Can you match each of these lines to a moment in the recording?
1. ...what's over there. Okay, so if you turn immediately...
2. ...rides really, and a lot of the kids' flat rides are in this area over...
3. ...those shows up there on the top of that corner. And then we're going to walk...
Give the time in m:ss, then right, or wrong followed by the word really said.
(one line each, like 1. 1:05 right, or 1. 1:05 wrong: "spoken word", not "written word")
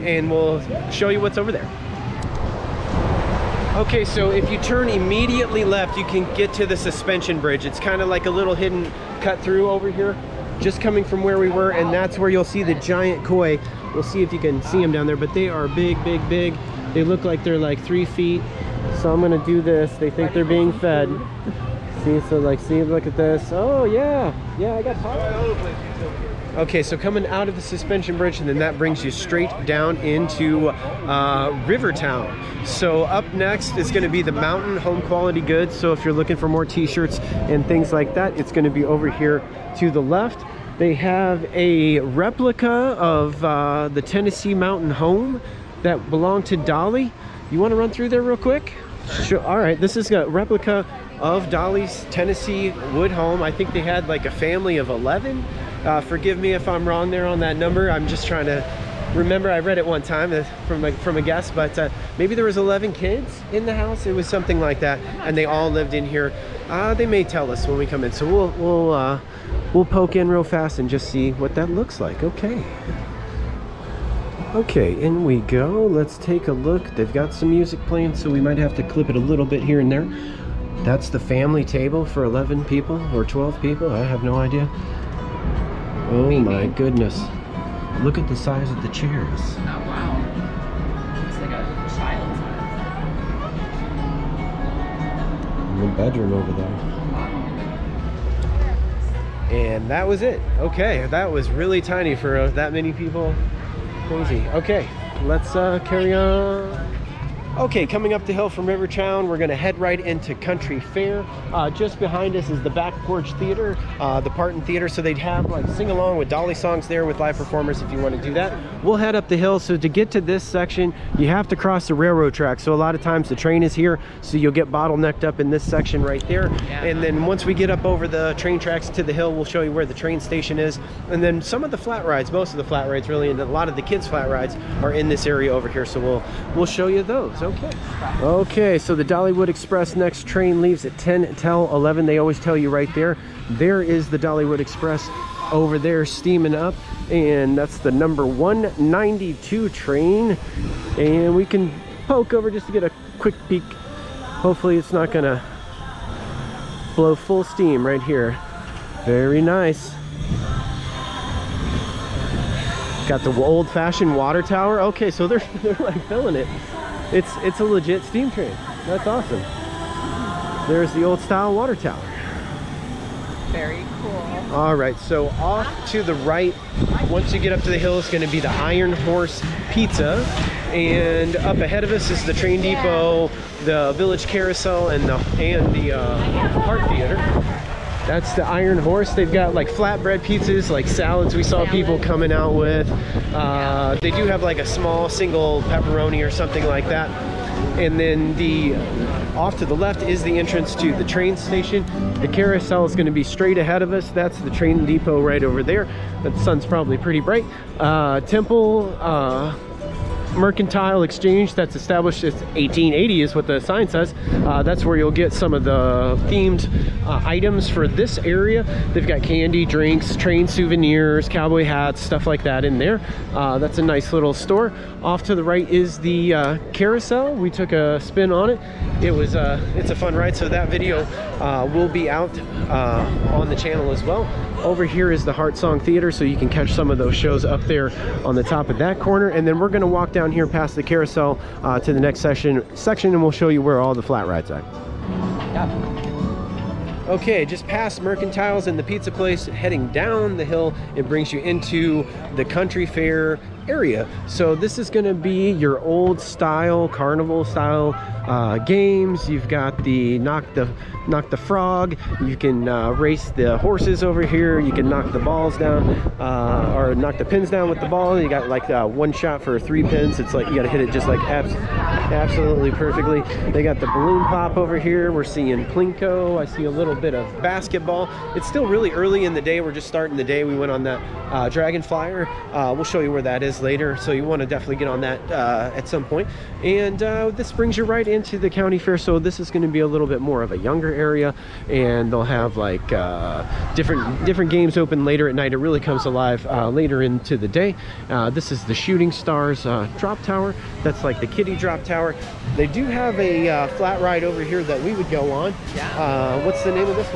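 1. 0:01 right
2. 2:12 right
3. 3:56 right.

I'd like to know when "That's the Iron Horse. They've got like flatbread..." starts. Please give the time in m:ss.
3:08.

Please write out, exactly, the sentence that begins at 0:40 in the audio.
They have a replica of uh, the Tennessee Mountain Home that belonged to Dolly.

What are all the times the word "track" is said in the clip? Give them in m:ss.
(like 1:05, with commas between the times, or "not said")
2:02, 2:08.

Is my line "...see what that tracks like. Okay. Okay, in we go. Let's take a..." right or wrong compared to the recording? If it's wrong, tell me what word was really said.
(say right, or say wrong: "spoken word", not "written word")
wrong: "looks", not "tracks".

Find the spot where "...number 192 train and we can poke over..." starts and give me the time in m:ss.
2:27.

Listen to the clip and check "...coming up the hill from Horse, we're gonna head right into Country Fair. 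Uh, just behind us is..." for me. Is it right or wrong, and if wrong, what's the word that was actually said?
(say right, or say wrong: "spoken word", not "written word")
wrong: "Rivertown", not "Horse".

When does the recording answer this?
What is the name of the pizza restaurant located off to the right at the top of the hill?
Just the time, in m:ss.
2:58.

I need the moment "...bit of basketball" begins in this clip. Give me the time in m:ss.
4:36.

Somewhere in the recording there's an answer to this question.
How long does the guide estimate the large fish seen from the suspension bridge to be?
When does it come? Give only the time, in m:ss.
0:17.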